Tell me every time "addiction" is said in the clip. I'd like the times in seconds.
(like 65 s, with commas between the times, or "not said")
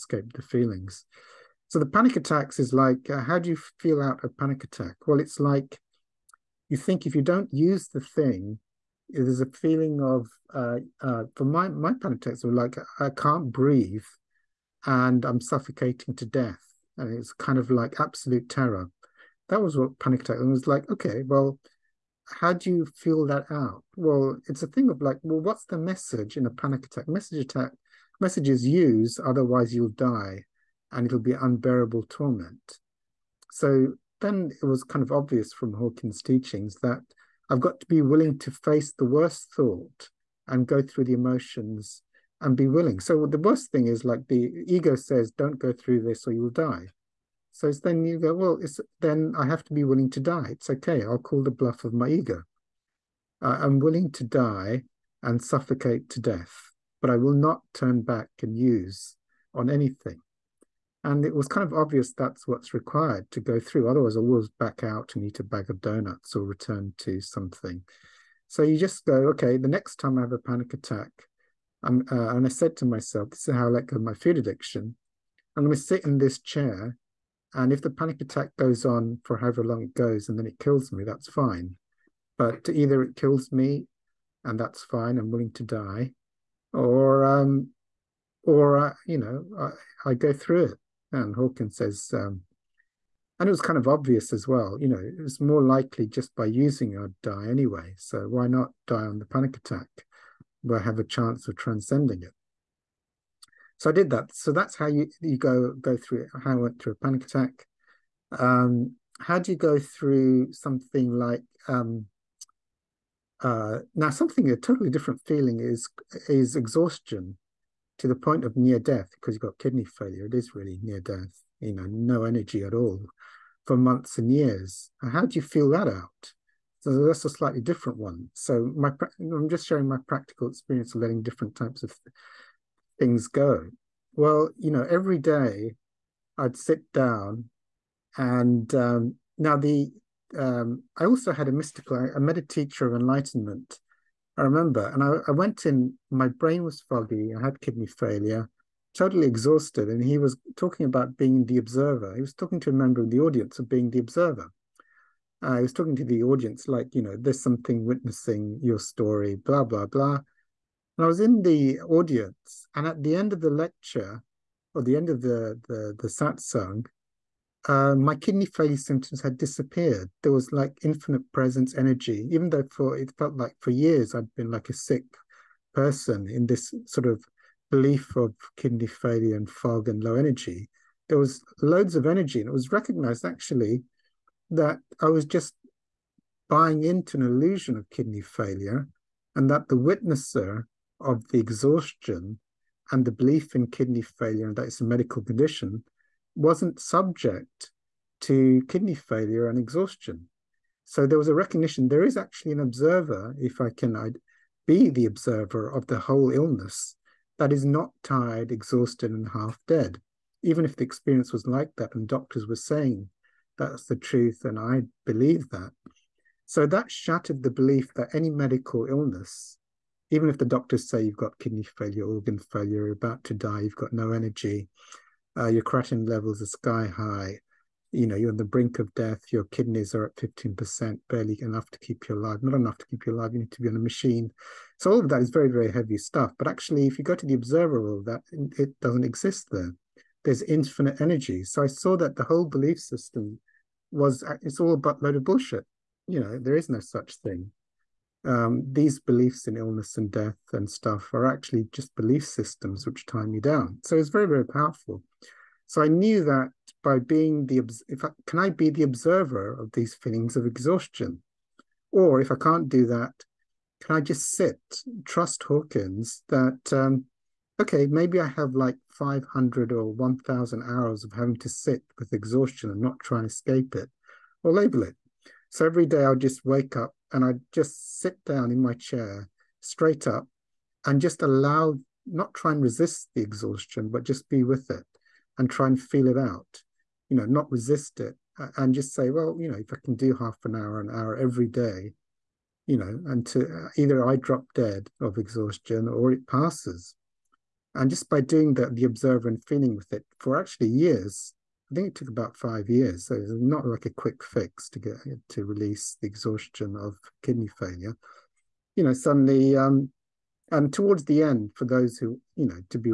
74 s.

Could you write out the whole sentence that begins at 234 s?
So all of that is very, very heavy stuff.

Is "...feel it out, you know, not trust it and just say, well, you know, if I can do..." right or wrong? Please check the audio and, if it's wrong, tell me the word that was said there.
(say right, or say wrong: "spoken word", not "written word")
wrong: "resist", not "trust".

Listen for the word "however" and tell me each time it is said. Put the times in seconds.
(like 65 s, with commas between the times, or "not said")
79 s.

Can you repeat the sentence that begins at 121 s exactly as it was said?
You know, no energy at all for months and years.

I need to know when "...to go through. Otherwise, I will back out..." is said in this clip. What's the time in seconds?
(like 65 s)
63 s.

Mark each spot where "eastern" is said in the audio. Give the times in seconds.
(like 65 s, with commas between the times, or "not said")
not said.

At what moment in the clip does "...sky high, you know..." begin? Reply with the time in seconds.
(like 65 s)
226 s.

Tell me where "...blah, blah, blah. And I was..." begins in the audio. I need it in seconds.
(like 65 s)
159 s.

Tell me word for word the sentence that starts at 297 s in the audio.
And just by doing that, the observer and feeling with it for actually years, I think it took about five years.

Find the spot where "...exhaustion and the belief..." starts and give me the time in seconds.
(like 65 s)
191 s.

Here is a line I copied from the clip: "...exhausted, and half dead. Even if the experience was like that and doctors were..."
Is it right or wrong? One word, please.
right.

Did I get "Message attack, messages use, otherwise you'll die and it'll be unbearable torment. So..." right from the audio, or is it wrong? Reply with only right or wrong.
right.